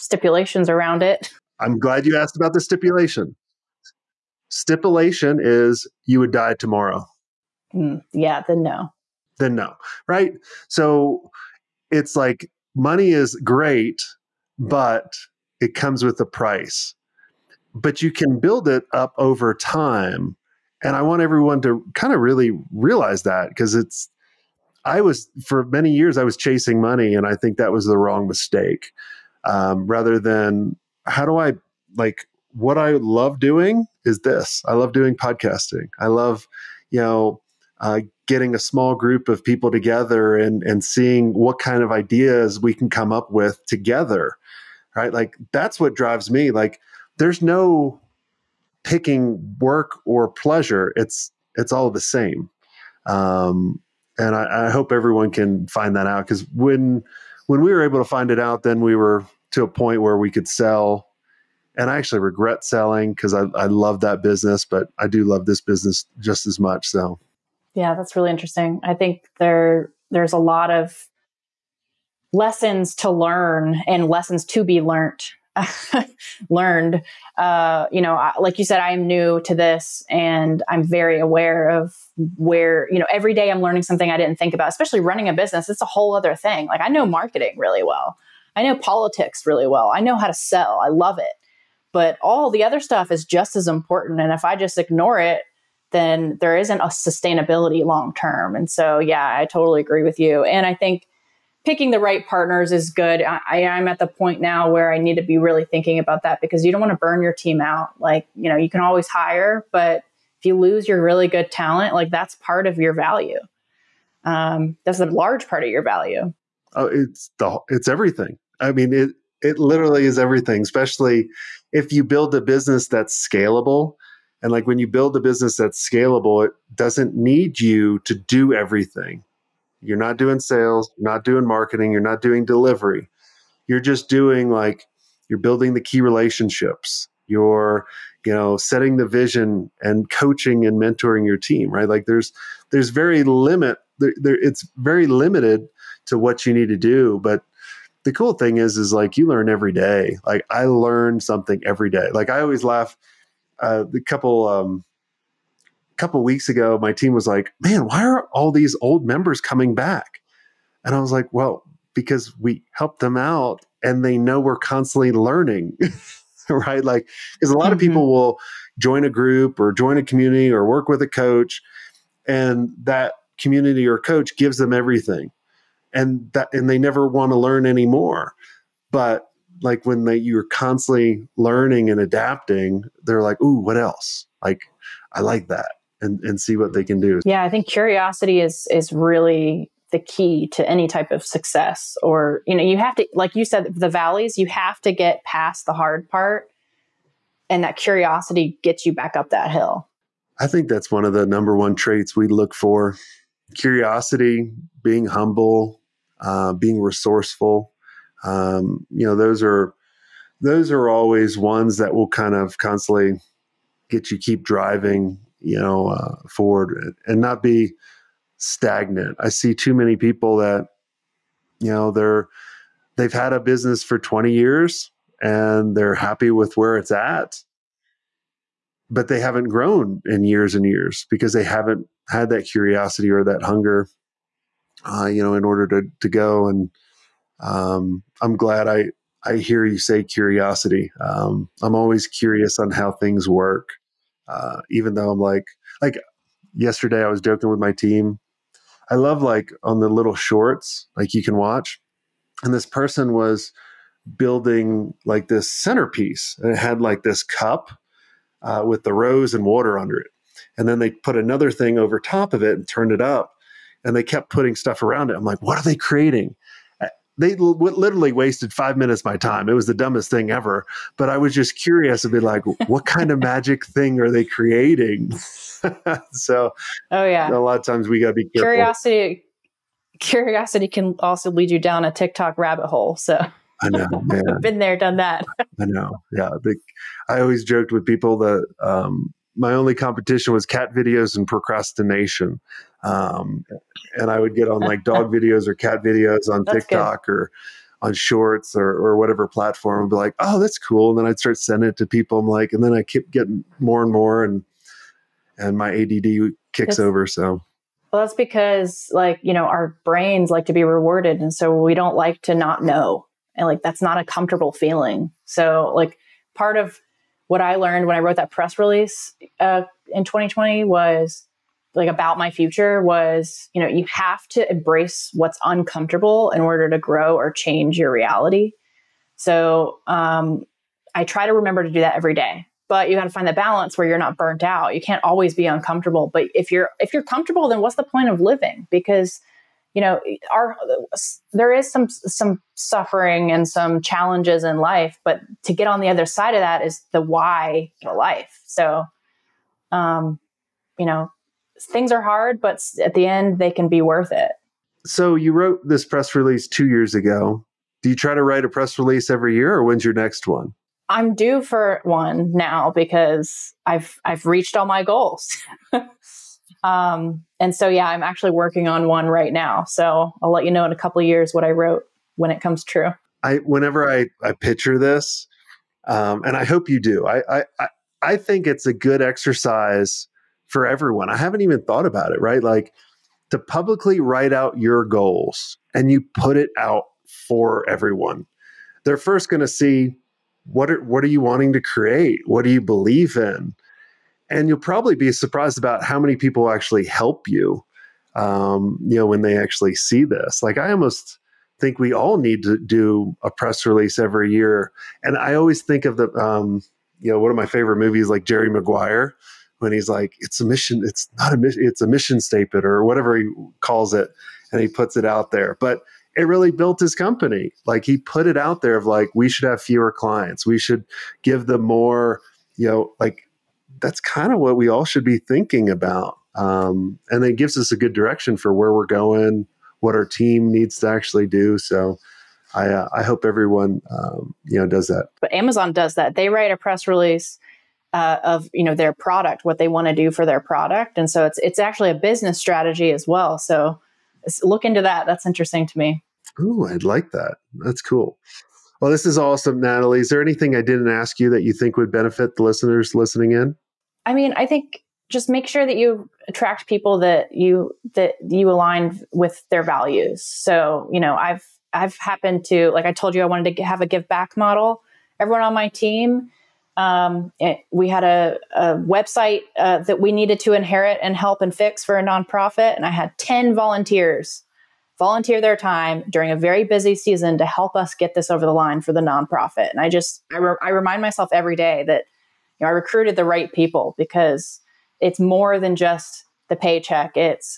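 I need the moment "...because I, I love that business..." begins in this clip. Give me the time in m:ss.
1:03.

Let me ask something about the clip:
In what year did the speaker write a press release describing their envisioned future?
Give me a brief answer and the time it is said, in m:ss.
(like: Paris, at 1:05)
2020, at 5:20.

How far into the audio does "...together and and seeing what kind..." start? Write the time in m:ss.
0:39.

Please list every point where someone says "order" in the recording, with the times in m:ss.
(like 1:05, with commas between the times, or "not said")
3:55, 5:26.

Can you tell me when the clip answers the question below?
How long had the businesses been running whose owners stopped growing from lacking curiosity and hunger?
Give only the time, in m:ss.
3:43.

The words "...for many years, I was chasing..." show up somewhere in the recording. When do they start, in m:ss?
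0:25.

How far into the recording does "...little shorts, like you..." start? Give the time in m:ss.
4:09.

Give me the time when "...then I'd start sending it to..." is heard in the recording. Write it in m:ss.
5:00.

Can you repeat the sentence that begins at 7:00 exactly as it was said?
We should give them more, you know, like that's kind of what we all should be thinking about.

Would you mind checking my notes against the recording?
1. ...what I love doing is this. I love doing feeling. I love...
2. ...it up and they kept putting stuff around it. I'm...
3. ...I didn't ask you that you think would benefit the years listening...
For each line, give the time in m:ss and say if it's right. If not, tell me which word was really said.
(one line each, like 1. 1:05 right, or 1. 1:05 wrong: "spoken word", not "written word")
1. 0:32 wrong: "podcasting", not "feeling"
2. 4:22 right
3. 7:30 wrong: "listeners", not "years".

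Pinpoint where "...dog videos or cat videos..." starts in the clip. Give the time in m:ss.
4:54.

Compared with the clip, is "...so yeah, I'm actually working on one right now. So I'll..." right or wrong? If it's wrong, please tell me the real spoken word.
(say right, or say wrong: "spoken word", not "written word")
right.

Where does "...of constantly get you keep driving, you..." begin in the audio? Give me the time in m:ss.
3:32.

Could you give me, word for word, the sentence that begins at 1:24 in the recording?
Especially running a business, it's a whole other thing.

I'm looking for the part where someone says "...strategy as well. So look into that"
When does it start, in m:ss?
7:22.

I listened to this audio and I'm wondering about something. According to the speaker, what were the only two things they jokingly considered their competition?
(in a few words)
Cat videos and procrastination.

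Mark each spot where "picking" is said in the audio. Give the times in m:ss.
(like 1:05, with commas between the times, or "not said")
0:48, 1:41.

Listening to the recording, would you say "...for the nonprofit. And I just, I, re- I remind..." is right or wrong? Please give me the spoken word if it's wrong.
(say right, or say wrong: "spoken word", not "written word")
right.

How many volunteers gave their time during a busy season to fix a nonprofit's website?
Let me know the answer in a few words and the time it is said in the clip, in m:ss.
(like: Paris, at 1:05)
10, at 7:53.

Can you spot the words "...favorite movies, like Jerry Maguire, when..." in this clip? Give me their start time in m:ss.
6:47.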